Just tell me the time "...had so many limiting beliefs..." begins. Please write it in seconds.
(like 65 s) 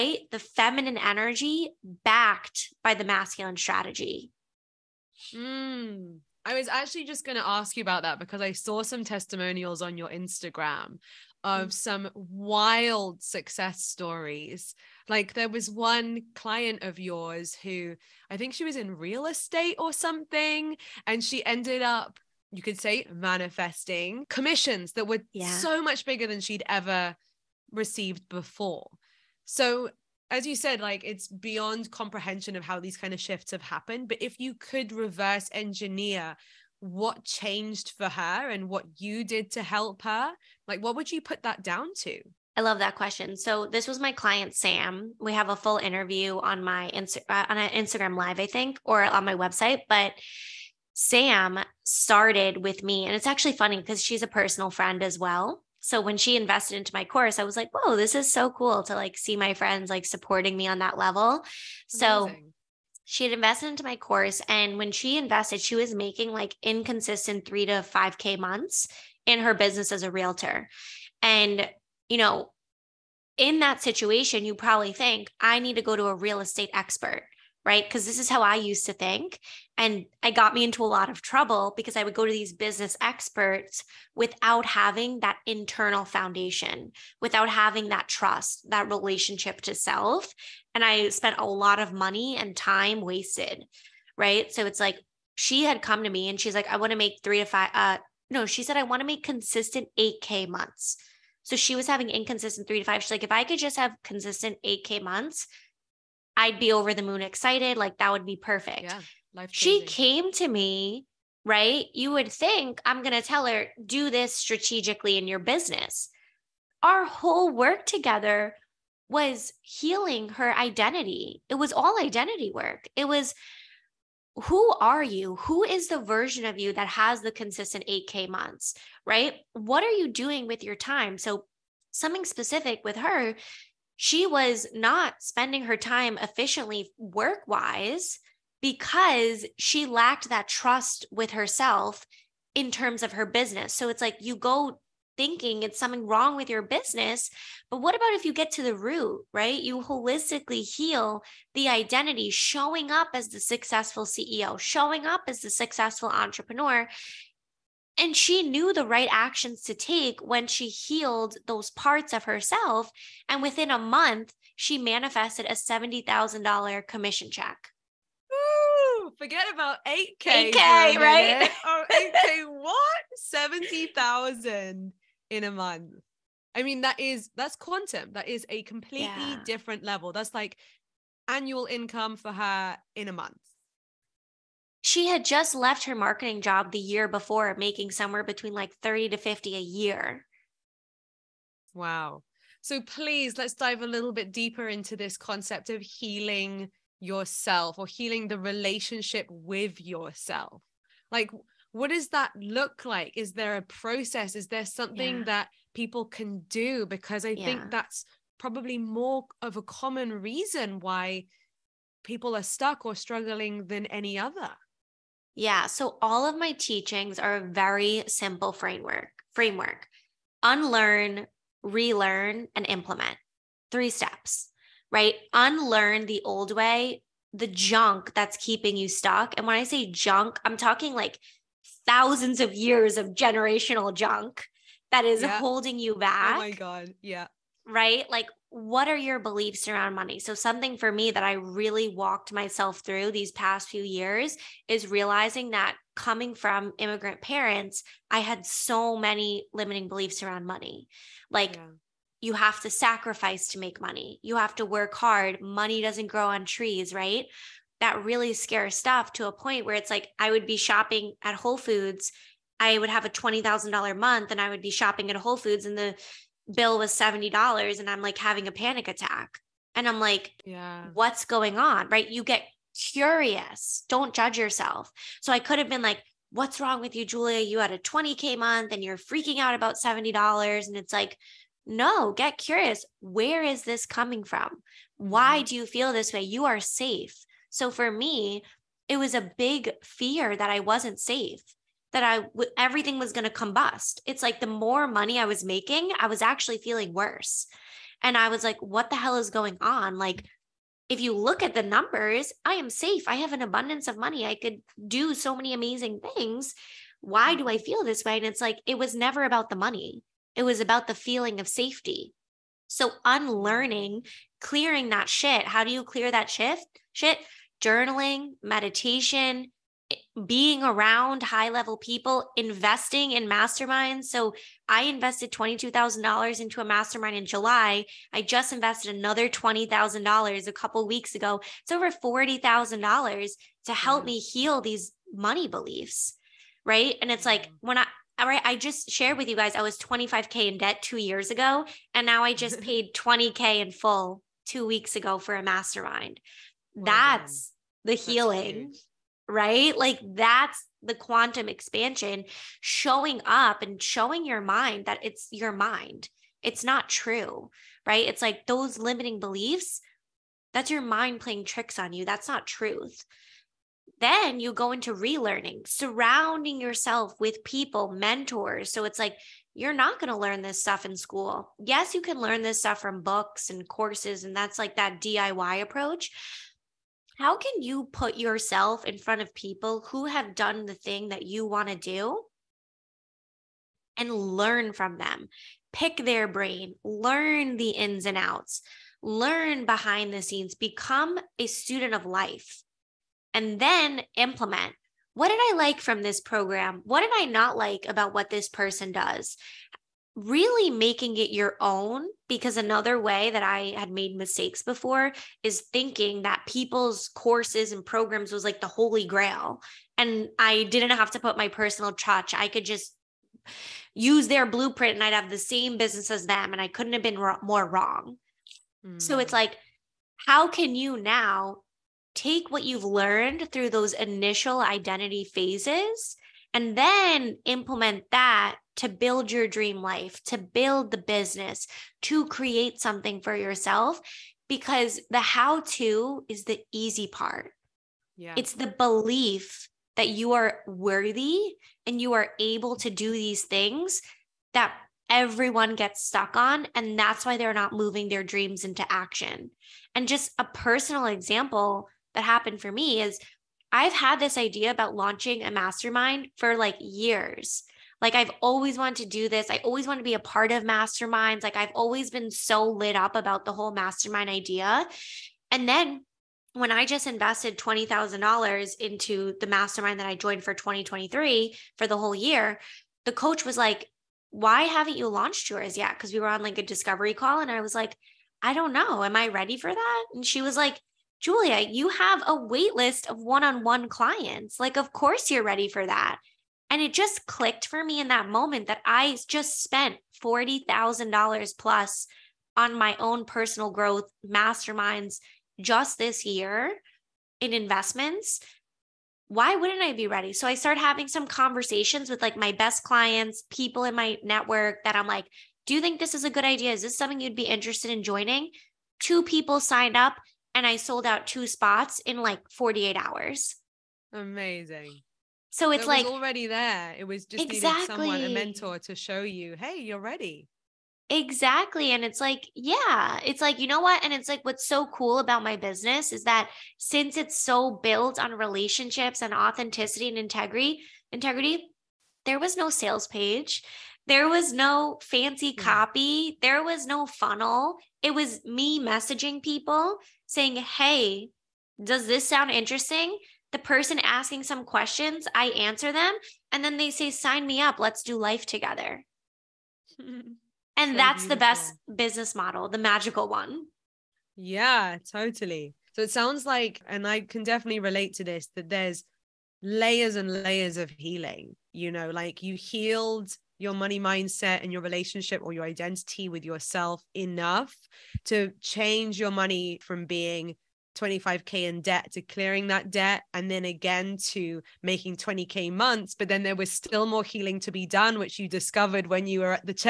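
248 s.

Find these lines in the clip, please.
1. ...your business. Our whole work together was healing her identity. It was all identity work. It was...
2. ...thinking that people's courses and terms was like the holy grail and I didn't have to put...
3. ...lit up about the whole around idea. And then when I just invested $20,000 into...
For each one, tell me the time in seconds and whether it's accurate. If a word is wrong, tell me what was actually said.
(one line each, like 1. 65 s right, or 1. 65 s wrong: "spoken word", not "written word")
1. 115 s right
2. 405 s wrong: "programs", not "terms"
3. 462 s wrong: "mastermind", not "around".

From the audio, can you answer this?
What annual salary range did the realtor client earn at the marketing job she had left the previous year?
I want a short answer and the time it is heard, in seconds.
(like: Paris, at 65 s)
30 to 50, at 188 s.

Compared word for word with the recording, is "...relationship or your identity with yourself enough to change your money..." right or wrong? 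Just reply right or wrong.
right.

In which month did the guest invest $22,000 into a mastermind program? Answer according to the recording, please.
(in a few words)
July.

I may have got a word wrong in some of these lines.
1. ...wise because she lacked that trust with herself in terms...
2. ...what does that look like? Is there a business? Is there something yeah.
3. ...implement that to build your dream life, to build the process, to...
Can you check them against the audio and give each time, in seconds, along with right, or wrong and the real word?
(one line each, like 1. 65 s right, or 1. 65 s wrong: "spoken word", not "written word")
1. 137 s right
2. 201 s wrong: "process", not "business"
3. 427 s wrong: "business", not "process".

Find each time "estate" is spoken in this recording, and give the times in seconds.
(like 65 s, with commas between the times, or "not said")
19 s, 76 s.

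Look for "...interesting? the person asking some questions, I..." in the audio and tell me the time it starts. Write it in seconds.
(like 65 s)
542 s.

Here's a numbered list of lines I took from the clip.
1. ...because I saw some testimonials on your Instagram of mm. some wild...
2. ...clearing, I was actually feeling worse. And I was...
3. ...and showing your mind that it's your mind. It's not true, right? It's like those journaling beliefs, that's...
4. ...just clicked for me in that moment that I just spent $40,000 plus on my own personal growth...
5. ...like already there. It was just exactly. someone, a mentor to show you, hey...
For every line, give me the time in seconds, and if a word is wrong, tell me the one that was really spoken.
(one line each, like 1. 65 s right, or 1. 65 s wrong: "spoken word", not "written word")
1. 8 s right
2. 295 s wrong: "making", not "clearing"
3. 353 s wrong: "limiting", not "journaling"
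4. 486 s right
5. 515 s right.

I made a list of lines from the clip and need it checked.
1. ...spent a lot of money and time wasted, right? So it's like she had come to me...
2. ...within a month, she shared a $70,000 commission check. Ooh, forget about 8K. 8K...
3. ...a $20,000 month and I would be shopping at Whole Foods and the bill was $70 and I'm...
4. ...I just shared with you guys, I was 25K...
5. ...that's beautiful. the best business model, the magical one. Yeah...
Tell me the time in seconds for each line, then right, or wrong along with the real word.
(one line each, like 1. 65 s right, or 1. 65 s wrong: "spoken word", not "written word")
1. 91 s right
2. 163 s wrong: "manifested", not "shared"
3. 263 s right
4. 338 s right
5. 550 s right.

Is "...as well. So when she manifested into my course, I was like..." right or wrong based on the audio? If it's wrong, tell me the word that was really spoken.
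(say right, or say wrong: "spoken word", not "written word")
wrong: "invested", not "manifested".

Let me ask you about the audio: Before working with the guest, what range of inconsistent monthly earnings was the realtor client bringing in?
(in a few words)
3 to 5K.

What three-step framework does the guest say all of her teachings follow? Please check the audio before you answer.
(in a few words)
Unlearn, relearn, and implement.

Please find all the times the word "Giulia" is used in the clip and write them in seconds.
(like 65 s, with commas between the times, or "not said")
277 s, 481 s.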